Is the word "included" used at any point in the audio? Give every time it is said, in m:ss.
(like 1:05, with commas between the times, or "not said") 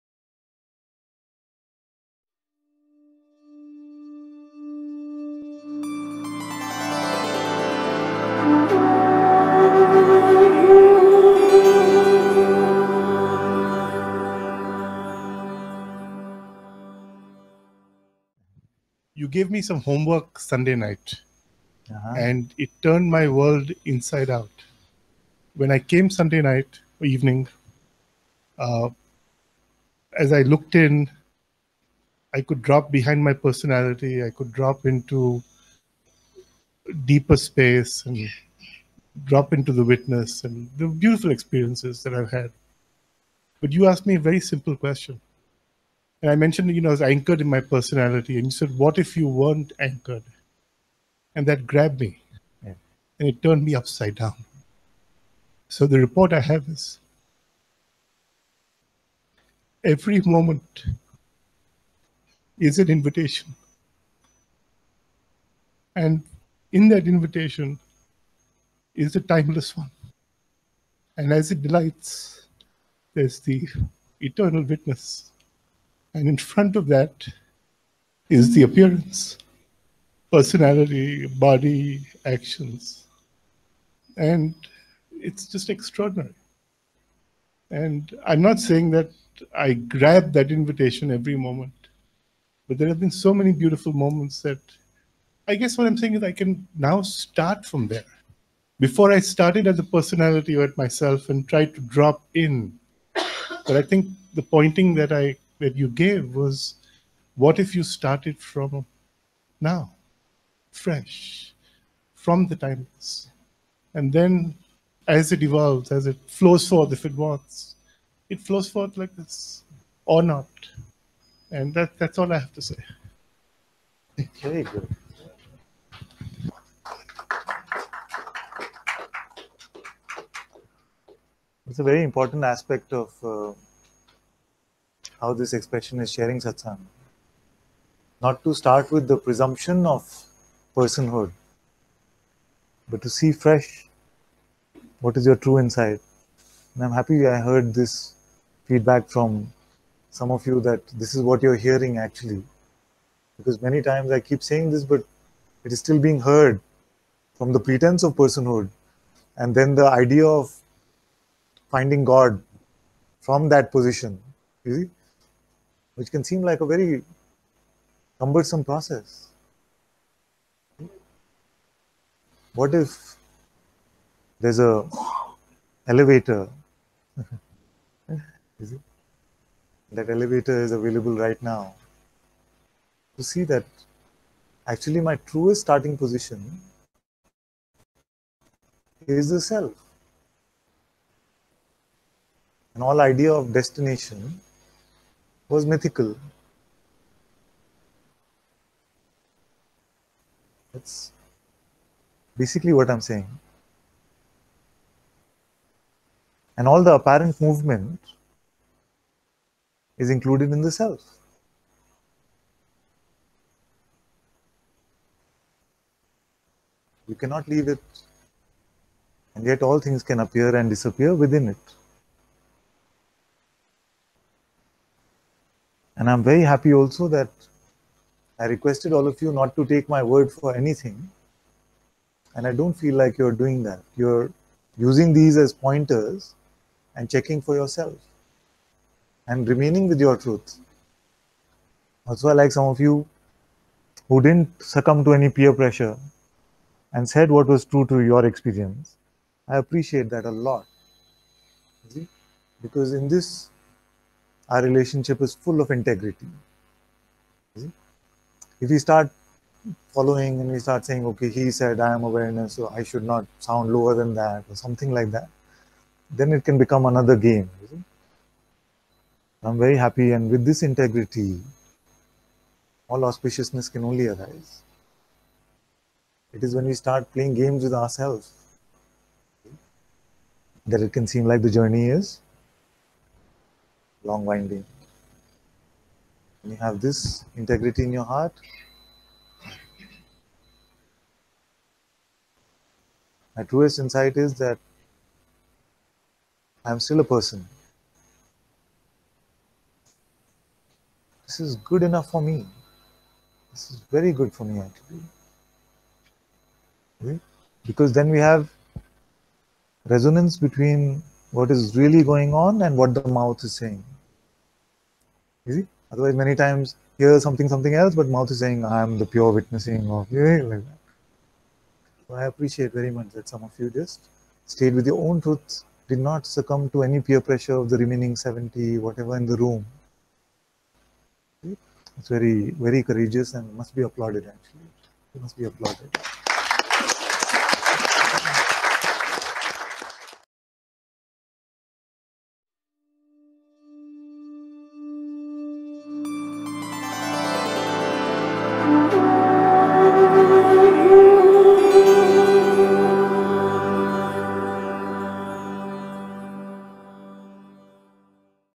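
3:30.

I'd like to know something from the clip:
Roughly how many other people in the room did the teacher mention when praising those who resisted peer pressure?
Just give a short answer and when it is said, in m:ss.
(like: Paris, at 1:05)
70, at 5:28.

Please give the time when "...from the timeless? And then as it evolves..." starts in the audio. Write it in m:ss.
1:52.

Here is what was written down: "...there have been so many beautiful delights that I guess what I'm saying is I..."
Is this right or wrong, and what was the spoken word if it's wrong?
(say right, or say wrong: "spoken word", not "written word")
wrong: "moments", not "delights".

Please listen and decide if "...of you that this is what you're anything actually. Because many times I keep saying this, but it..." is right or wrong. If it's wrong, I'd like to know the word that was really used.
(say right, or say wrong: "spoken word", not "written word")
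wrong: "hearing", not "anything".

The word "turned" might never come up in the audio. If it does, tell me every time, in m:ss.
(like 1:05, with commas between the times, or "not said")
0:22, 0:53.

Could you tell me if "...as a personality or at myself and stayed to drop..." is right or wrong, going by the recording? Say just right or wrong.
wrong.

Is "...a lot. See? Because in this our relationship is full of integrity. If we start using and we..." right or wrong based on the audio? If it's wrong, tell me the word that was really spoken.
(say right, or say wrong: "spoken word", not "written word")
wrong: "following", not "using".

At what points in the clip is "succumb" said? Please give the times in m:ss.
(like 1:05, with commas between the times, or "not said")
4:04, 5:26.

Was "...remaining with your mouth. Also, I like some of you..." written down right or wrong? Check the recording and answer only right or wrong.
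wrong.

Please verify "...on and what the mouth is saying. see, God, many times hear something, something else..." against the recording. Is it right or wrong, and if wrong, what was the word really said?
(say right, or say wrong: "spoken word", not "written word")
wrong: "Otherwise", not "God".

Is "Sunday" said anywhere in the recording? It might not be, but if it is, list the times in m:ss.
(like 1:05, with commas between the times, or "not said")
0:20, 0:26.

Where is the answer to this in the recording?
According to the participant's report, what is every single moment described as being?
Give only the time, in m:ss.
0:59.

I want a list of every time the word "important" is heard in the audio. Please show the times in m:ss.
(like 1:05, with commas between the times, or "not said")
2:12.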